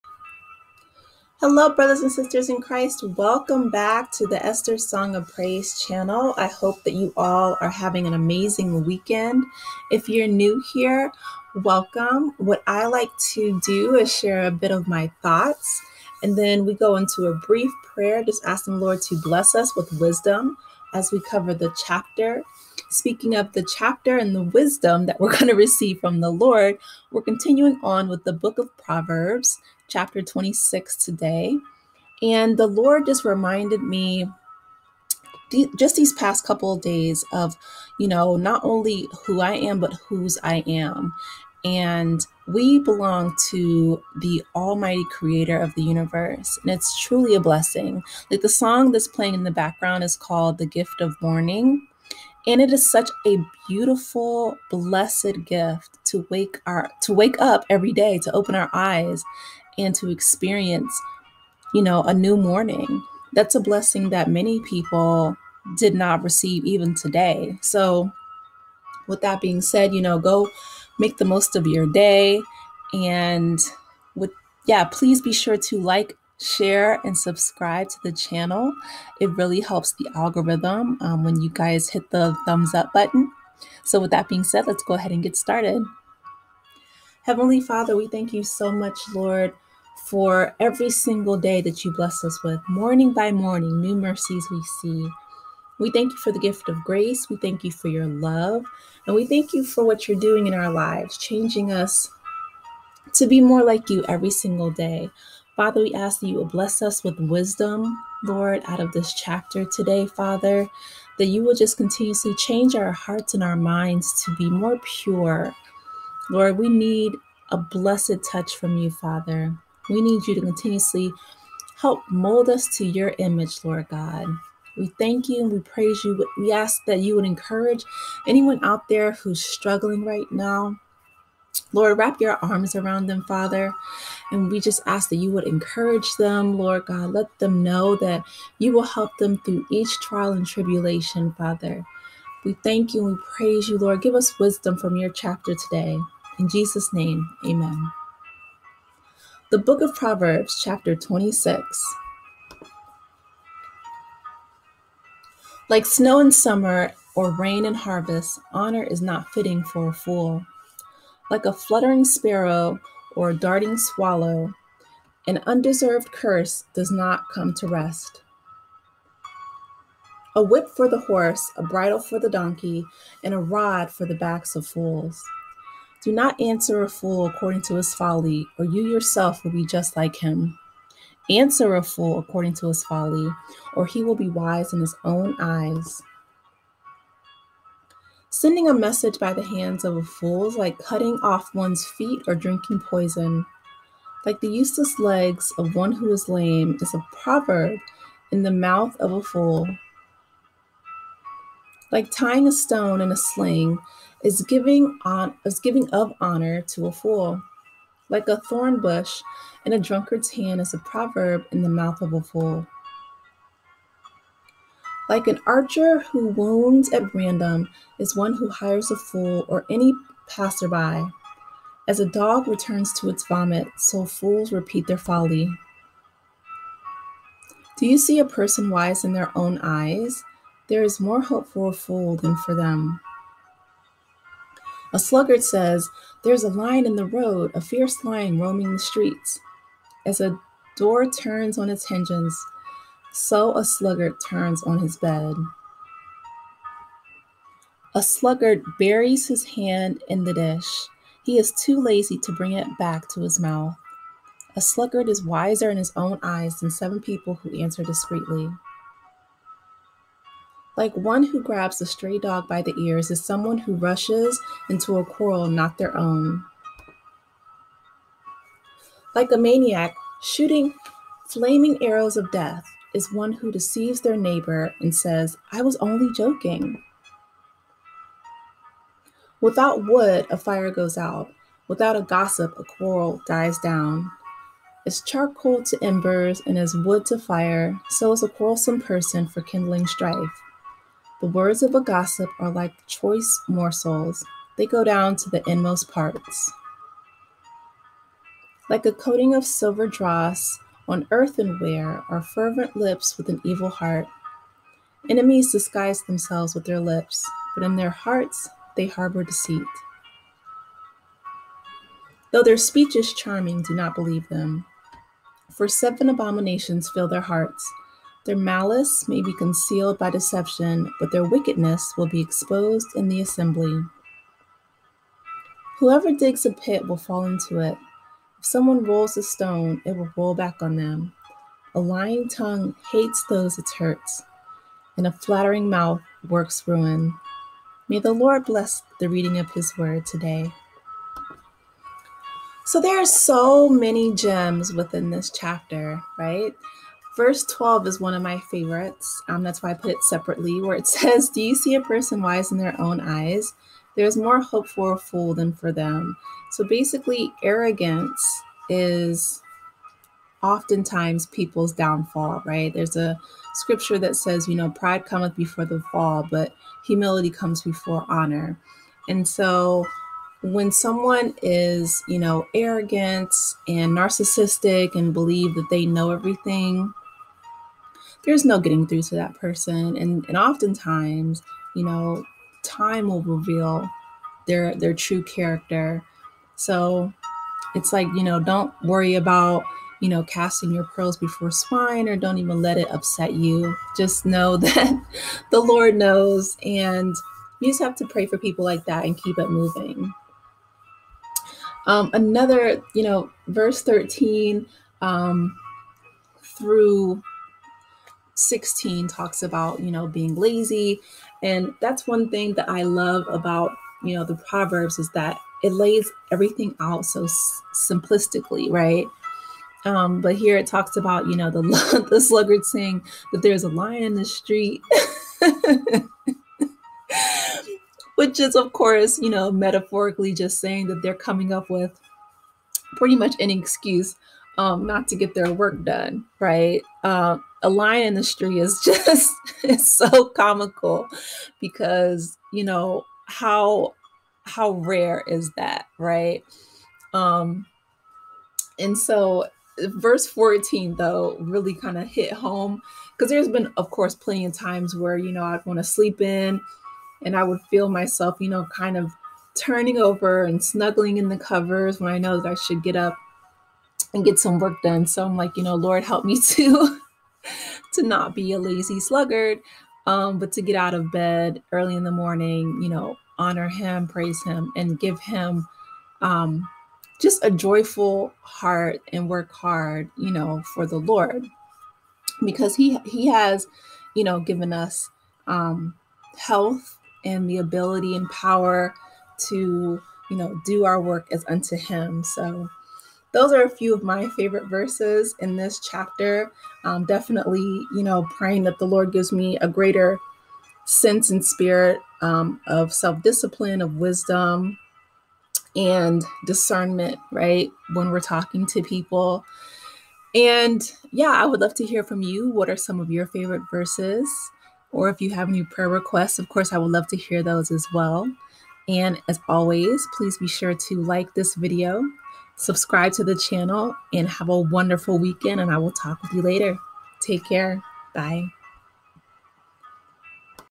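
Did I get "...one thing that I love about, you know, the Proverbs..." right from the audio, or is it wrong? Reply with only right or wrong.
right.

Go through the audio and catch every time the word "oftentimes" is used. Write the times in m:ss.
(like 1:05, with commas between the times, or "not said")
6:00, 6:20.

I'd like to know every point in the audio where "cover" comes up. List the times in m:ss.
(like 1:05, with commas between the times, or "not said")
0:21, 7:41.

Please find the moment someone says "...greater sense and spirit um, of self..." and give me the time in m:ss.
8:19.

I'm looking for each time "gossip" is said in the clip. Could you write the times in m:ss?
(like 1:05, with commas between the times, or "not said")
4:42, 4:51.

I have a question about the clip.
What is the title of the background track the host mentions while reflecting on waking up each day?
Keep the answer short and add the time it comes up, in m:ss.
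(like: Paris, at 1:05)
The Gift of Morning, at 0:50.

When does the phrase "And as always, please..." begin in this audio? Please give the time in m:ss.
8:38.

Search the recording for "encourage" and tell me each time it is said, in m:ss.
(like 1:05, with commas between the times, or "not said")
2:07, 2:15.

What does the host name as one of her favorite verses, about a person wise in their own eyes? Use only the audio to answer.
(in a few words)
Verse 12.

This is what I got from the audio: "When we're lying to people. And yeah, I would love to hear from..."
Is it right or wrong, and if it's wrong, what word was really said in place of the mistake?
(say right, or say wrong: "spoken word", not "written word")
wrong: "talking", not "lying".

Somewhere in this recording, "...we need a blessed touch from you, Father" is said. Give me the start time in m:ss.
1:56.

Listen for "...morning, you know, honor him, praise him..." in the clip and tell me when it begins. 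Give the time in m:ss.
7:52.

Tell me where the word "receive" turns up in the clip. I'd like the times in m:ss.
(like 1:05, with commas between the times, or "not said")
0:25, 1:06.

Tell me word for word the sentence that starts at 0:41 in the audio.
And we belong to the almighty creator of the universe.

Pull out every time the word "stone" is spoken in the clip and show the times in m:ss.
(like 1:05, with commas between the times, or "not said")
3:22, 5:29.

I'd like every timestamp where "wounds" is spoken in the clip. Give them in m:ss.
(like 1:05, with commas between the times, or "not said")
3:36.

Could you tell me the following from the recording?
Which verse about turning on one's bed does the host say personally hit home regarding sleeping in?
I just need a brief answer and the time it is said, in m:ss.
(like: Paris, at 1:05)
Verse 14, at 7:29.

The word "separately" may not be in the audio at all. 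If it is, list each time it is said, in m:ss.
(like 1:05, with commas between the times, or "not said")
5:50.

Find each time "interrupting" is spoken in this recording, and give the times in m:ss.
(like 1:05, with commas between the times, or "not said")
not said.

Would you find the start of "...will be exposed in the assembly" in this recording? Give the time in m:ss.
5:21.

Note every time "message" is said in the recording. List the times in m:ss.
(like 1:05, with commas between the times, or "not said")
3:08.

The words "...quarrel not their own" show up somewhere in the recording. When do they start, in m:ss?
4:25.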